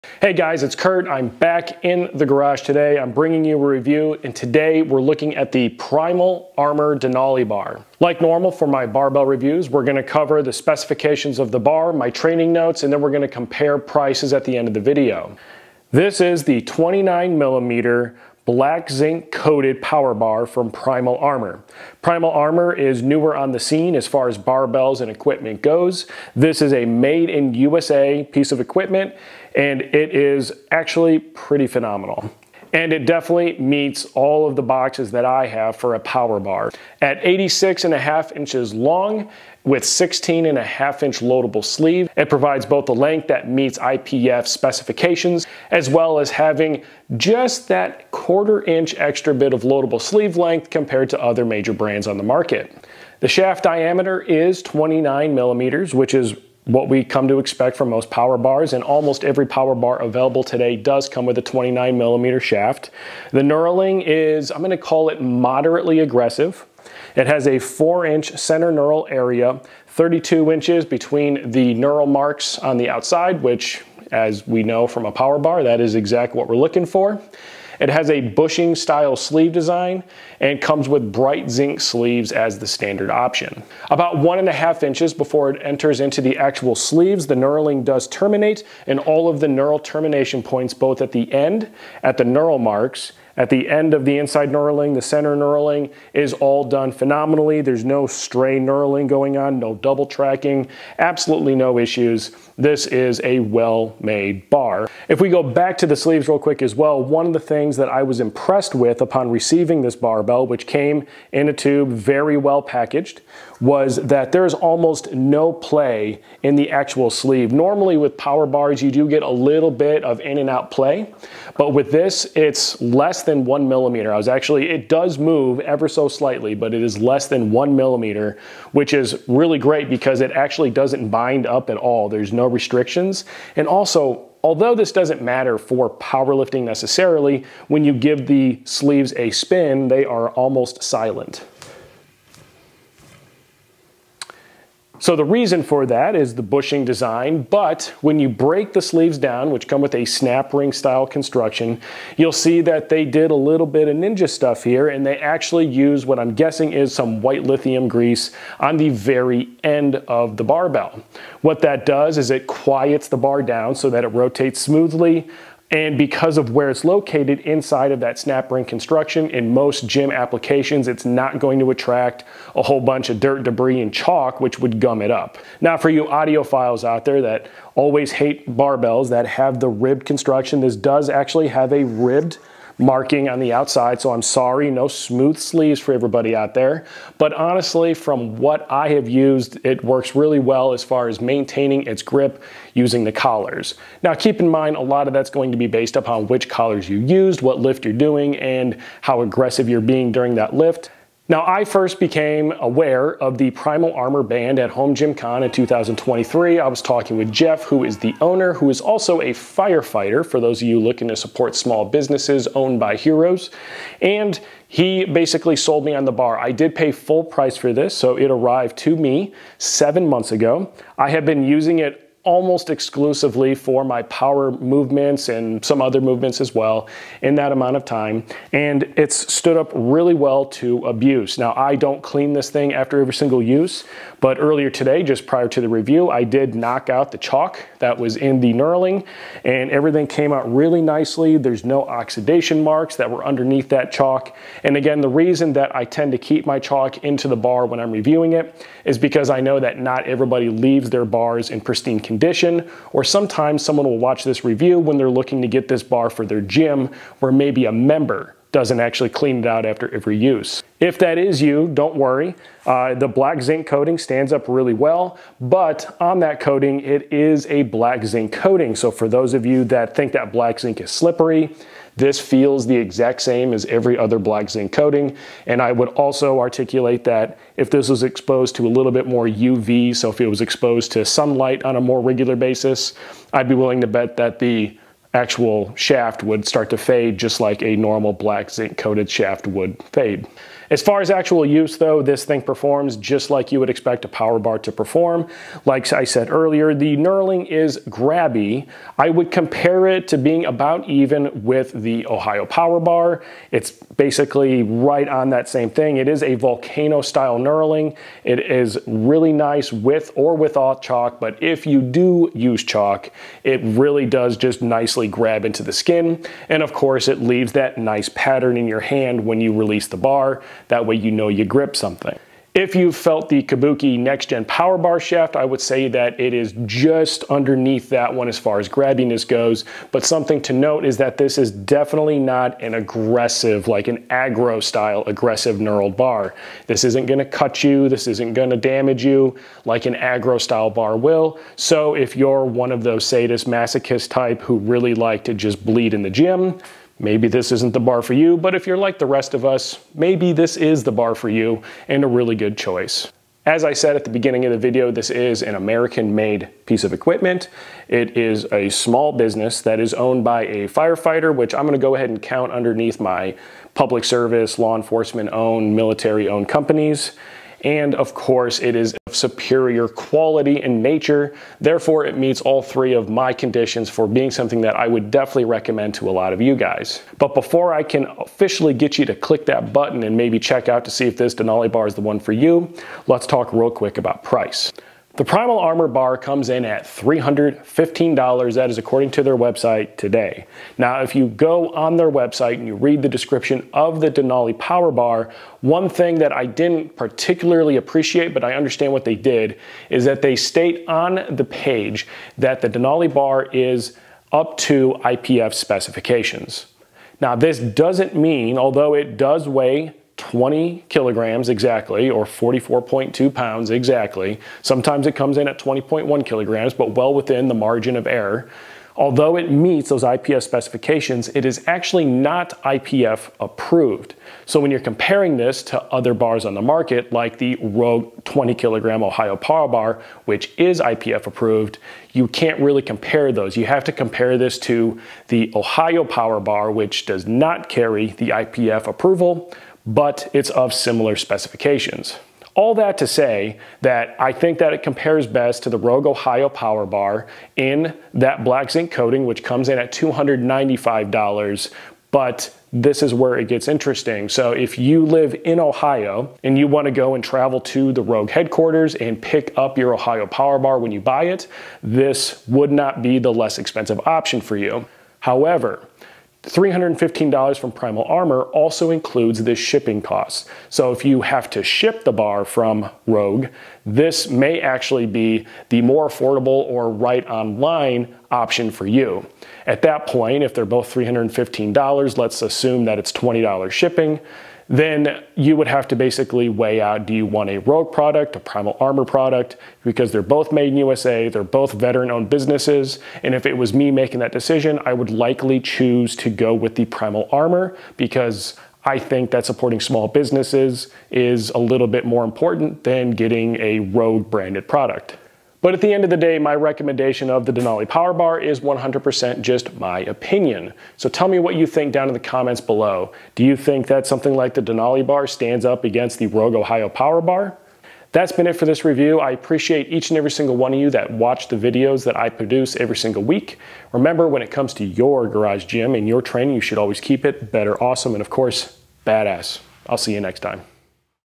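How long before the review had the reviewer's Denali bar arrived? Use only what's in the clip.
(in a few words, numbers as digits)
7 months.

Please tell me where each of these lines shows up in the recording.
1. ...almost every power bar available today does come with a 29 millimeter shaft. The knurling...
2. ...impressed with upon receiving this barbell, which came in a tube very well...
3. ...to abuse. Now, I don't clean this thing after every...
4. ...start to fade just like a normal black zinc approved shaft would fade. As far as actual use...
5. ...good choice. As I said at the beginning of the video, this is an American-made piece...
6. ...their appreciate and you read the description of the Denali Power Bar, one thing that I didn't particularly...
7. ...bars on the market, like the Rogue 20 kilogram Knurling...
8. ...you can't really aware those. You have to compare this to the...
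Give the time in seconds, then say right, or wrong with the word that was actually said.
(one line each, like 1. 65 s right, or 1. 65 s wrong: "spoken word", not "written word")
1. 58 s right
2. 108 s right
3. 230 s right
4. 286 s wrong: "coated", not "approved"
5. 352 s right
6. 391 s wrong: "website", not "appreciate"
7. 426 s wrong: "Ohio", not "Knurling"
8. 432 s wrong: "compare", not "aware".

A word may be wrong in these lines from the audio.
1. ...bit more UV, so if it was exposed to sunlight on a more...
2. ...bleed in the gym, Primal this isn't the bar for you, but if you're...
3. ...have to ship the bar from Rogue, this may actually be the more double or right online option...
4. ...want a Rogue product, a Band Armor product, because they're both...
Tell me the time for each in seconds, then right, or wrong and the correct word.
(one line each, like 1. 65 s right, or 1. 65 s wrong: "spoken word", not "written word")
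1. 278 s right
2. 345 s wrong: "Maybe", not "Primal"
3. 471 s wrong: "affordable", not "double"
4. 487 s wrong: "Primal", not "Band".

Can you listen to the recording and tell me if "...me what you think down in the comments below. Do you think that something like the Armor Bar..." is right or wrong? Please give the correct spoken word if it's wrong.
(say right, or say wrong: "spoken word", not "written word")
wrong: "Denali", not "Armor".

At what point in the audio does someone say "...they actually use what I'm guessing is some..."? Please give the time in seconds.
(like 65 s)
155 s.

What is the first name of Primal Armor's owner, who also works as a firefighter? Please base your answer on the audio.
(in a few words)
Jeff.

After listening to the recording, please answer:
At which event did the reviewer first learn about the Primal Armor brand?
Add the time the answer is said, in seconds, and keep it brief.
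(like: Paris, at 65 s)
Home Gym Con, at 204 s.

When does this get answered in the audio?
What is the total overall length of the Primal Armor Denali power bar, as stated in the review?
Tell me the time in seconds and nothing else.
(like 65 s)
37 s.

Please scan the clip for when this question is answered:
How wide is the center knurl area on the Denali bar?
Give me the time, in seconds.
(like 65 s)
67 s.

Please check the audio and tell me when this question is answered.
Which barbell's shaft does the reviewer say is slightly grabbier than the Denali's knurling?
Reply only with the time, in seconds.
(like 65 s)
323 s.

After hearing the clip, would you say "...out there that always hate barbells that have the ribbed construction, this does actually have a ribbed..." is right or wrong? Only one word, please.
right.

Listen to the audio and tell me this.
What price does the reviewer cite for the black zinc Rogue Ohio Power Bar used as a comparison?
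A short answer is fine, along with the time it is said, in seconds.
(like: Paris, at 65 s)
$295, at 449 s.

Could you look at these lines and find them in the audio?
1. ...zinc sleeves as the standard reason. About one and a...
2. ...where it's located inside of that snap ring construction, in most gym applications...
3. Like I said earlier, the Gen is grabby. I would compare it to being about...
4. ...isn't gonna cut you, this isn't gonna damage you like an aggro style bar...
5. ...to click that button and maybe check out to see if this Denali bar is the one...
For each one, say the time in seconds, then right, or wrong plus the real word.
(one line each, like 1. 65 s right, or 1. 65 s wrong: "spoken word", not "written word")
1. 81 s wrong: "option", not "reason"
2. 166 s right
3. 295 s wrong: "Knurling", not "Gen"
4. 336 s right
5. 379 s right.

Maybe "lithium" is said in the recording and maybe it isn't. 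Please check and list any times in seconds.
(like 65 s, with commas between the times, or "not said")
157 s.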